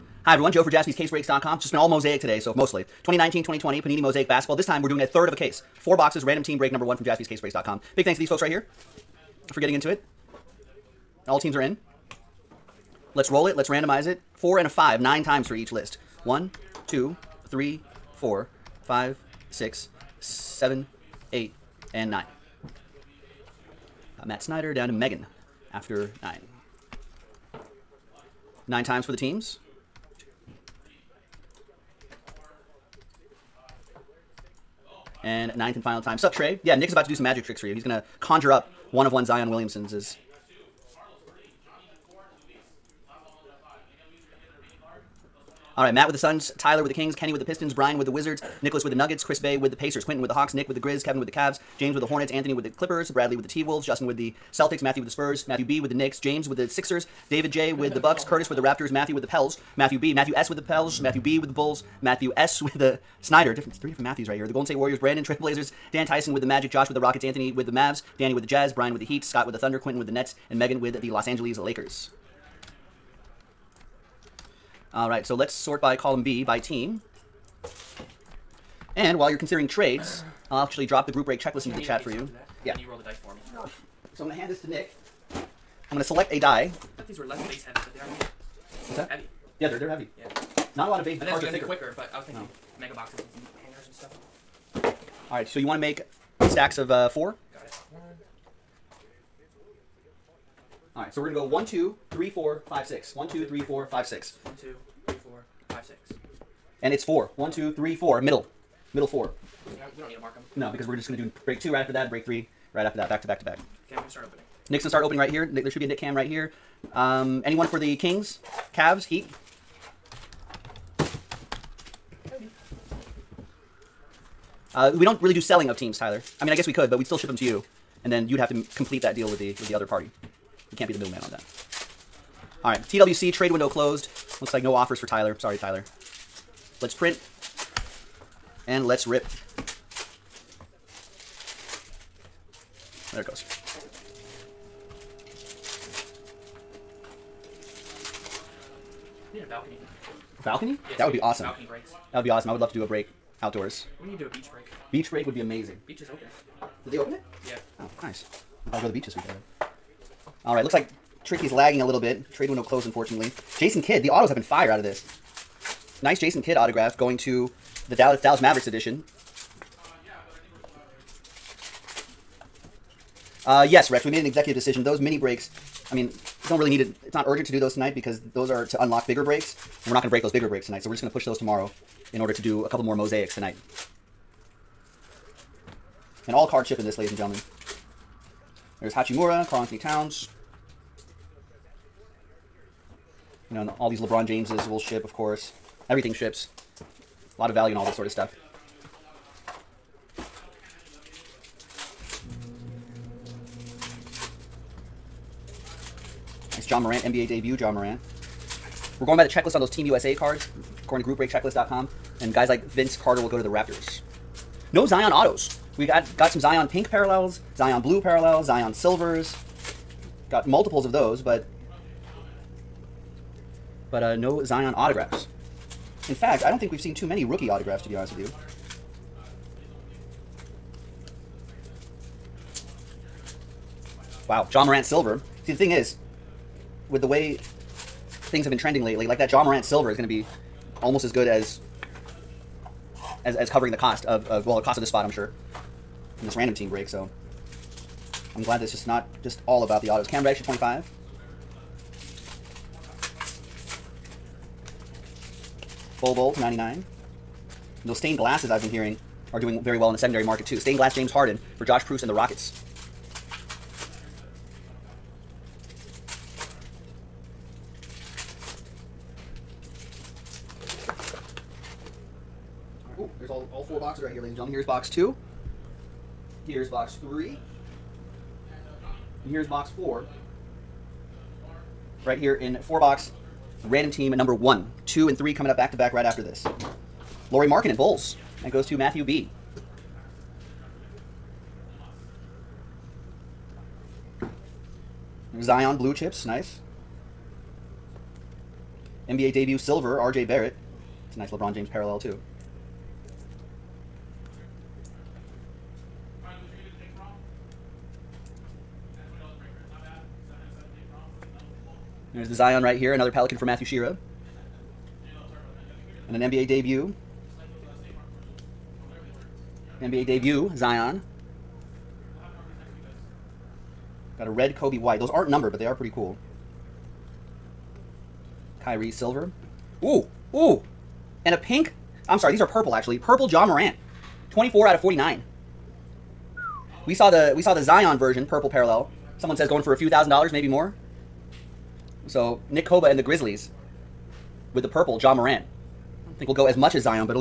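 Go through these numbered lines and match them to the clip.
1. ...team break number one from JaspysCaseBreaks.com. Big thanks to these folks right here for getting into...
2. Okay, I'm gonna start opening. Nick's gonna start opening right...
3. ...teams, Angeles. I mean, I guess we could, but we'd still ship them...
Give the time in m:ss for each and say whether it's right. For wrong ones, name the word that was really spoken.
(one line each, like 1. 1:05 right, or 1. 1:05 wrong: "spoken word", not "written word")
1. 0:06 right
2. 1:53 right
3. 2:05 wrong: "Tyler", not "Angeles".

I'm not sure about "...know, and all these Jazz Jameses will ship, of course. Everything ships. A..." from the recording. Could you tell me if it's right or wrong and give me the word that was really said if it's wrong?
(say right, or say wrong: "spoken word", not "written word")
wrong: "LeBron", not "Jazz".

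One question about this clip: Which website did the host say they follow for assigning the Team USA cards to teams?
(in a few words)
groupbreakchecklist.com.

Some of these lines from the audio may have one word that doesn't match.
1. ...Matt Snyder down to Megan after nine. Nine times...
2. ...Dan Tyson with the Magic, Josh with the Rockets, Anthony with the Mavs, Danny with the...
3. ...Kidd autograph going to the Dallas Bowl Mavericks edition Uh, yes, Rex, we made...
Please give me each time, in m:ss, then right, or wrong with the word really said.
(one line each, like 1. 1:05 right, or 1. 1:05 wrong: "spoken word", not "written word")
1. 0:24 right
2. 1:05 right
3. 2:46 wrong: "Dallas", not "Bowl".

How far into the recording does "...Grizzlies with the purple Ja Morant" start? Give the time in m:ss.
5:43.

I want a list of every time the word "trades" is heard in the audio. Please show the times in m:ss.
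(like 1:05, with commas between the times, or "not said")
1:19, 2:13, 2:42.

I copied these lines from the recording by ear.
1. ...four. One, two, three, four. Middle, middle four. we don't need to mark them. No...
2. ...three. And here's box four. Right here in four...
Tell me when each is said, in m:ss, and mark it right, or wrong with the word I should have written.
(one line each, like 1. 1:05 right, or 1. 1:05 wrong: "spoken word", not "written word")
1. 1:47 right
2. 4:37 right.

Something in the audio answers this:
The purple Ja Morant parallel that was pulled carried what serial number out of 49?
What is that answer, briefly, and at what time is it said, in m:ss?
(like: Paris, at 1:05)
24, at 5:34.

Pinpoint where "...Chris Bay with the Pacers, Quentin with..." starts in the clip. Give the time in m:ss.
0:49.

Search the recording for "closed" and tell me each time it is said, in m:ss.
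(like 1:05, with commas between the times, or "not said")
2:13, 2:42.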